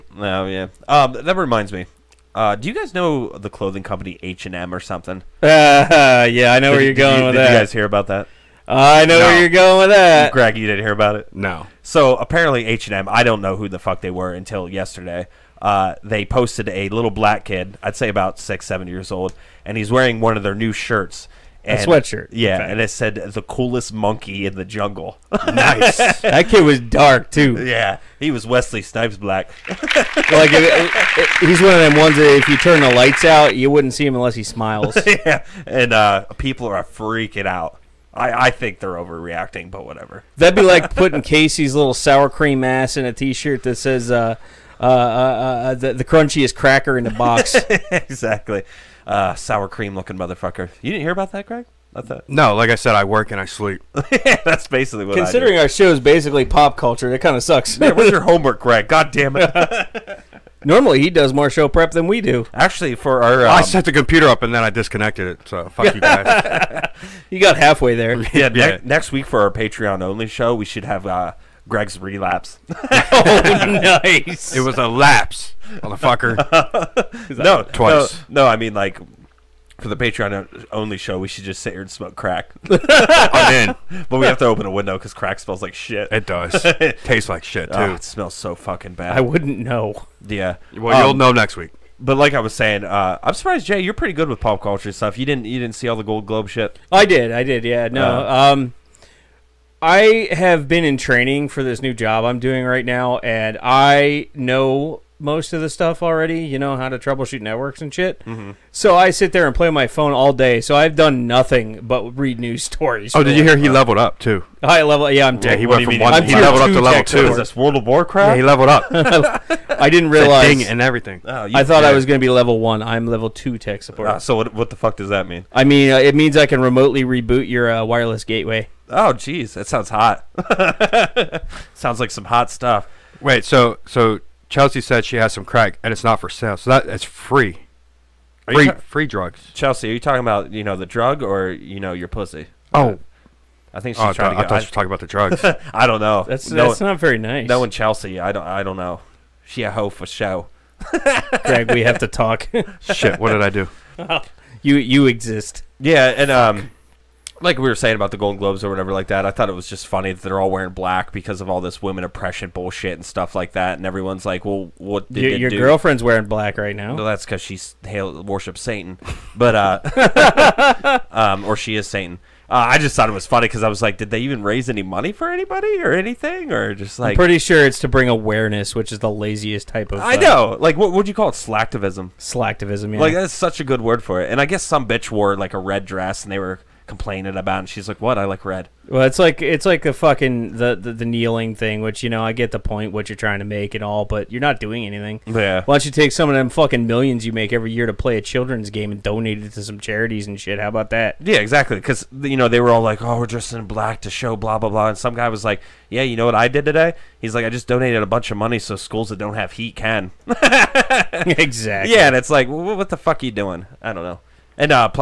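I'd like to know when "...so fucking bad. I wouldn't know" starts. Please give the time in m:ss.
1:28.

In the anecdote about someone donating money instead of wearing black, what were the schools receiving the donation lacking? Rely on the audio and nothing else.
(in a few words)
Heat.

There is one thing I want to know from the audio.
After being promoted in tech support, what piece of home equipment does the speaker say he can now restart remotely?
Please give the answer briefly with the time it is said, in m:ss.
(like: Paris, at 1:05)
Wireless gateway, at 2:07.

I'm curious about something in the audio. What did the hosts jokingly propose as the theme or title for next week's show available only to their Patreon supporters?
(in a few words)
Greg's relapse.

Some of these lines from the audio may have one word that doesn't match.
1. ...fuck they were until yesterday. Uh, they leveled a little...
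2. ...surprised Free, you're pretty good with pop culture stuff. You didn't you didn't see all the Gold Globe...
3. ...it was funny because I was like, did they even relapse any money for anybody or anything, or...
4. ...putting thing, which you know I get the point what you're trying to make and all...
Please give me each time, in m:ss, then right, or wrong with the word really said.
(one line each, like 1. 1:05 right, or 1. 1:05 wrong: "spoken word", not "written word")
1. 0:13 wrong: "posted", not "leveled"
2. 1:33 wrong: "Jay", not "Free"
3. 2:53 wrong: "raise", not "relapse"
4. 3:11 wrong: "kneeling", not "putting".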